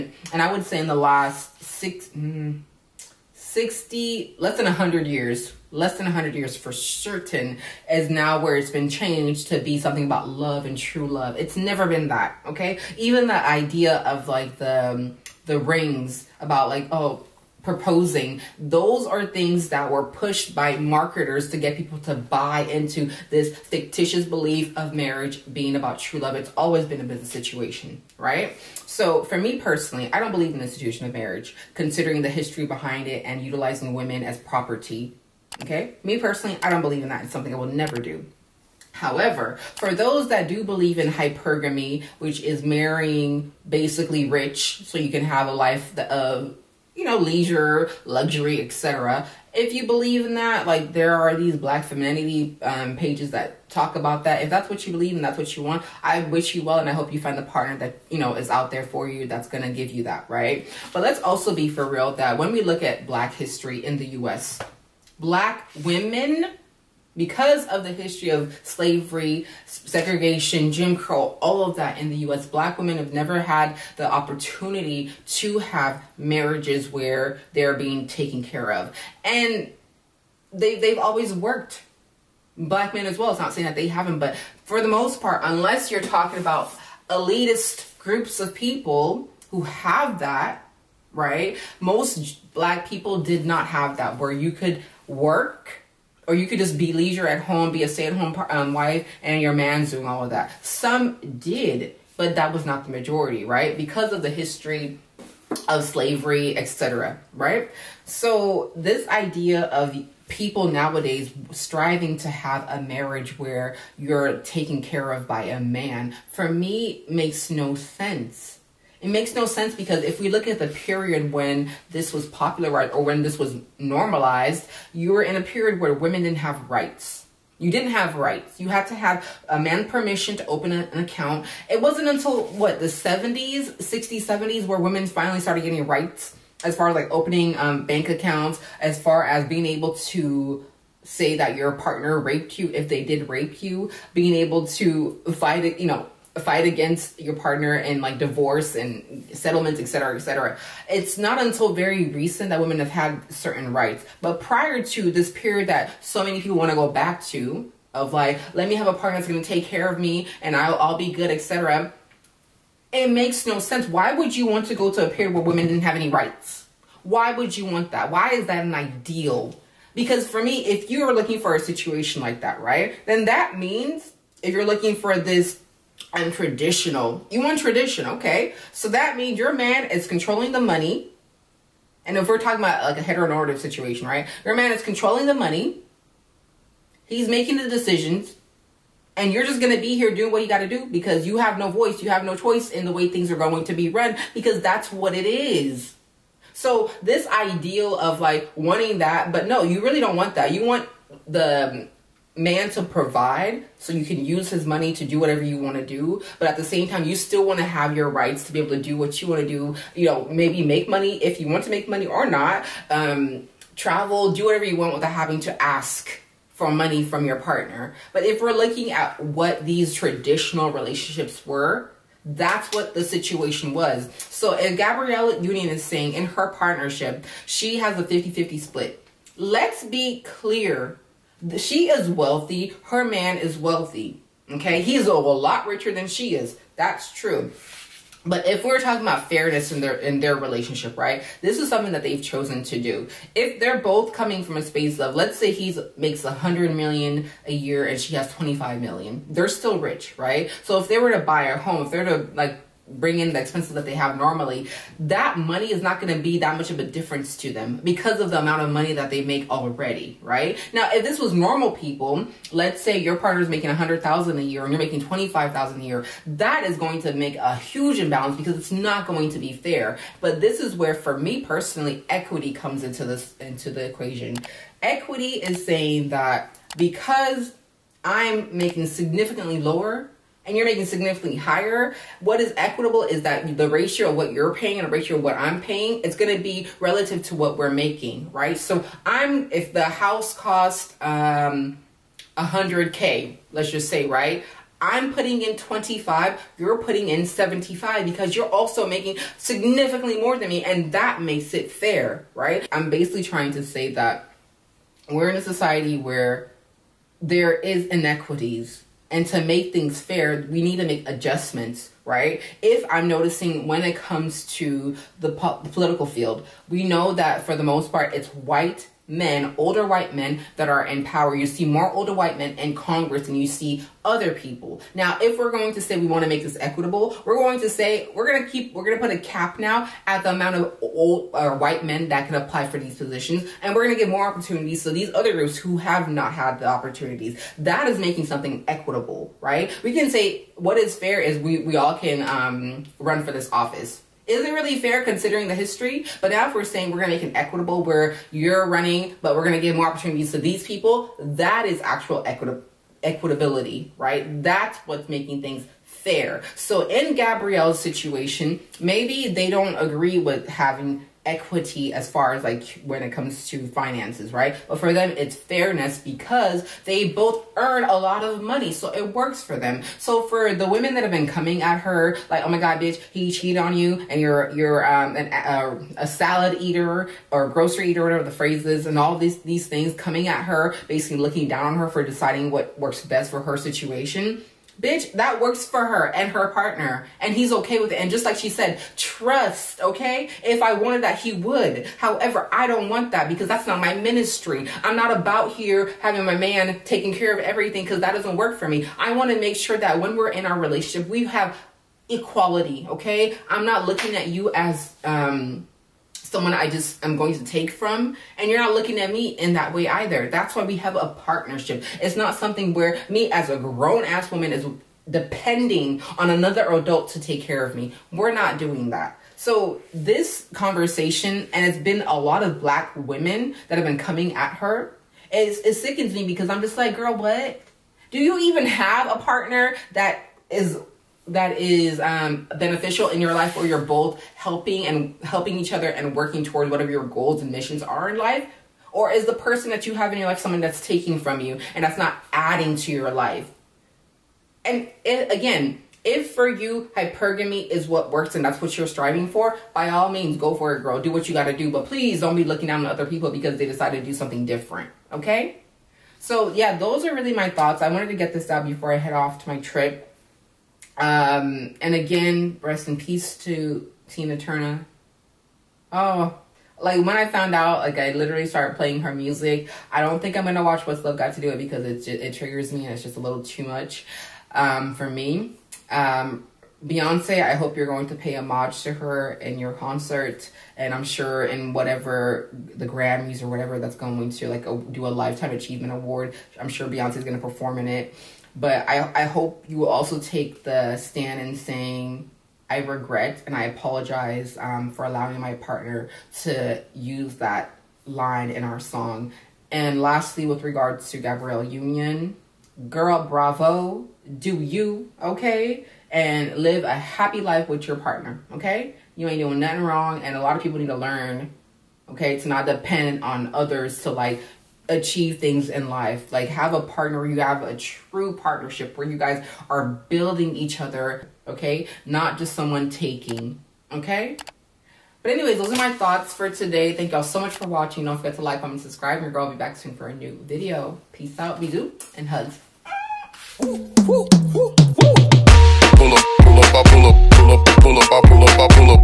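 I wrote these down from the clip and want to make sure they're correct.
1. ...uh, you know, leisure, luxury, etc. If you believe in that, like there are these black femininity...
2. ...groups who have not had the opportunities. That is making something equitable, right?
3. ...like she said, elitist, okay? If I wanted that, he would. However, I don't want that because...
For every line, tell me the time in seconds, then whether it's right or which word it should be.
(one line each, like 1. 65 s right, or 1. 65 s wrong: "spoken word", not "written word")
1. 46 s right
2. 335 s right
3. 388 s wrong: "trust", not "elitist".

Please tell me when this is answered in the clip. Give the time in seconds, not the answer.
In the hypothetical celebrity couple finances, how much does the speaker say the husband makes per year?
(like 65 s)
246 s.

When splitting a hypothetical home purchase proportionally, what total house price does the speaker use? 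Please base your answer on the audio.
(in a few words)
100k.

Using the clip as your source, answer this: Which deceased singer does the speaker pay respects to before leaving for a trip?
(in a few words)
Tina Turner.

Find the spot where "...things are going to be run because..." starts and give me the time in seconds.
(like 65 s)
193 s.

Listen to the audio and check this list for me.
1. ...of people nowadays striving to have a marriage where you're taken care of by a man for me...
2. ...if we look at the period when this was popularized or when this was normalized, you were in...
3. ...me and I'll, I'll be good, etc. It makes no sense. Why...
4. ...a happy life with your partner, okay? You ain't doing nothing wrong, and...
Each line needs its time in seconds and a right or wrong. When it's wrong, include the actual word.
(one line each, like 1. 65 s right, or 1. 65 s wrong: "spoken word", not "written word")
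1. 109 s right
2. 120 s right
3. 159 s right
4. 506 s right.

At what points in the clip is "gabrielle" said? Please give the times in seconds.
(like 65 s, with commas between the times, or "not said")
224 s, 357 s, 501 s.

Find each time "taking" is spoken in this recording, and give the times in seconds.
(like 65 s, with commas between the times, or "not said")
396 s, 440 s, 522 s.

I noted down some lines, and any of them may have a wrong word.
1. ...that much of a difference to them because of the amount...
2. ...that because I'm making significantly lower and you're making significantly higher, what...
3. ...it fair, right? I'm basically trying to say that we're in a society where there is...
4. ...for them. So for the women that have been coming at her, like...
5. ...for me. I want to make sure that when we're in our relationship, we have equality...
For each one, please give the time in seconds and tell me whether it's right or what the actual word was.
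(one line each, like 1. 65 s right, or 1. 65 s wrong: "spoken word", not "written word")
1. 256 s right
2. 276 s right
3. 301 s right
4. 369 s right
5. 398 s right.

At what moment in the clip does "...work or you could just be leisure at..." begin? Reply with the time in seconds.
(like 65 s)
95 s.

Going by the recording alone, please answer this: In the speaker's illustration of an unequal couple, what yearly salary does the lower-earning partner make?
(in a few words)
25,000.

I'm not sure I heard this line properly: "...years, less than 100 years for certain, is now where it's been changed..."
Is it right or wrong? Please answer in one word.
right.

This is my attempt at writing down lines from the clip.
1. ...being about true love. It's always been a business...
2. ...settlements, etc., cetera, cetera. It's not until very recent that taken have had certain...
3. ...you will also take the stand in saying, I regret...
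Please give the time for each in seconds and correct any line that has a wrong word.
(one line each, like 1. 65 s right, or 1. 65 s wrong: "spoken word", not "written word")
1. 25 s right
2. 149 s wrong: "women", not "taken"
3. 489 s right.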